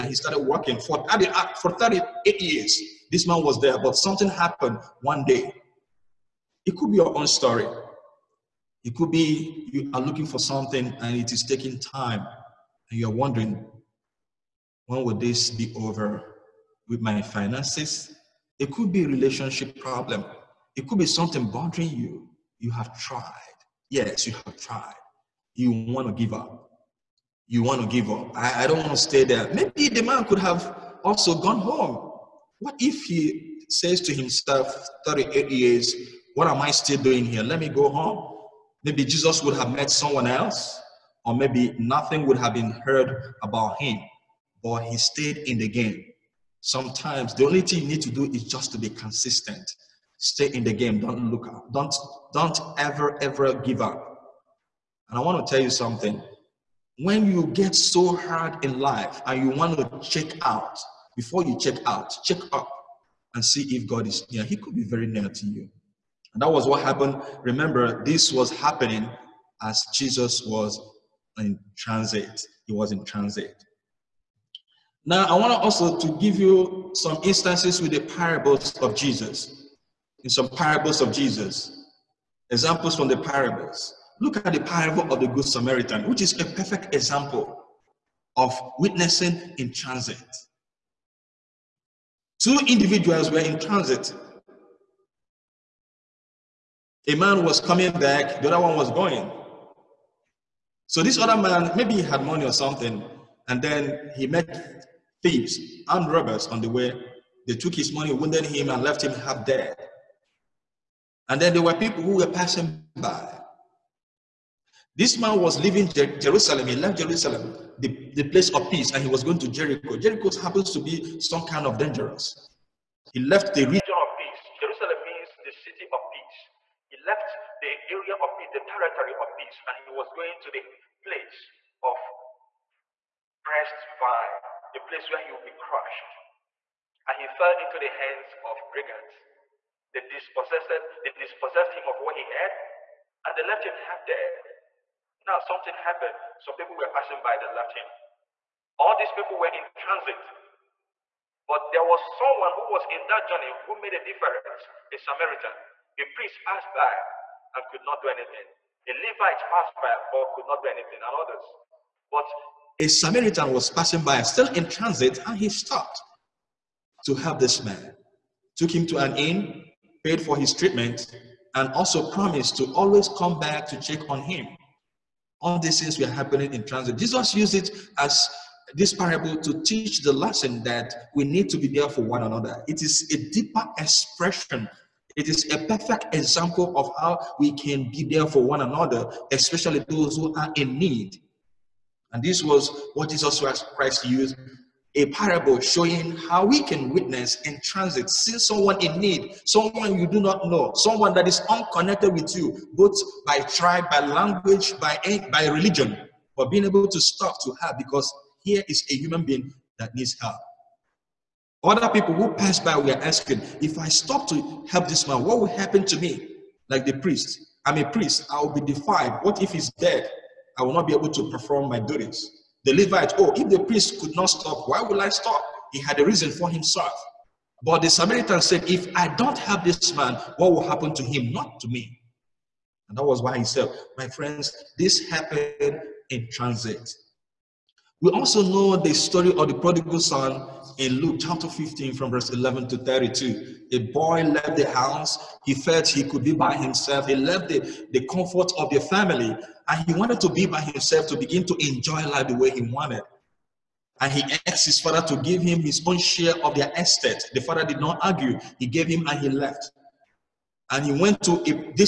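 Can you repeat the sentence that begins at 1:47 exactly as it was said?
They took his money, wounded him, and left him half dead.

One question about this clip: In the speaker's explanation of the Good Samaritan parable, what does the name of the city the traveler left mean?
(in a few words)
the city of peace.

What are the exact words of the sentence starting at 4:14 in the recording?
And he asked his father to give him his own share of their estate.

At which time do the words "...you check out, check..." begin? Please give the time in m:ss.
1:01.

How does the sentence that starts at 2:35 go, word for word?
A priest passed by and could not do anything.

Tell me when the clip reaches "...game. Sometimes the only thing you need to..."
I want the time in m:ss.
0:45.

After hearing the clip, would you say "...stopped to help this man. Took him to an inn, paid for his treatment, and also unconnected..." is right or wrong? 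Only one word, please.
wrong.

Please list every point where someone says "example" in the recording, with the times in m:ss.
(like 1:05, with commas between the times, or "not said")
1:22, 1:26, 3:06.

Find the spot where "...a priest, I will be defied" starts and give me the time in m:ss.
3:37.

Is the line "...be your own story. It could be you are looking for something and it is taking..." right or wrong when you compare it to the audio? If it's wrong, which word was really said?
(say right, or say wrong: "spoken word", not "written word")
right.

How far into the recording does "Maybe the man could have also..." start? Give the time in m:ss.
0:29.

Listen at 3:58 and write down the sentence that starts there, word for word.
We also know the story of the prodigal son in Luke chapter 15 from verse 11 to 32.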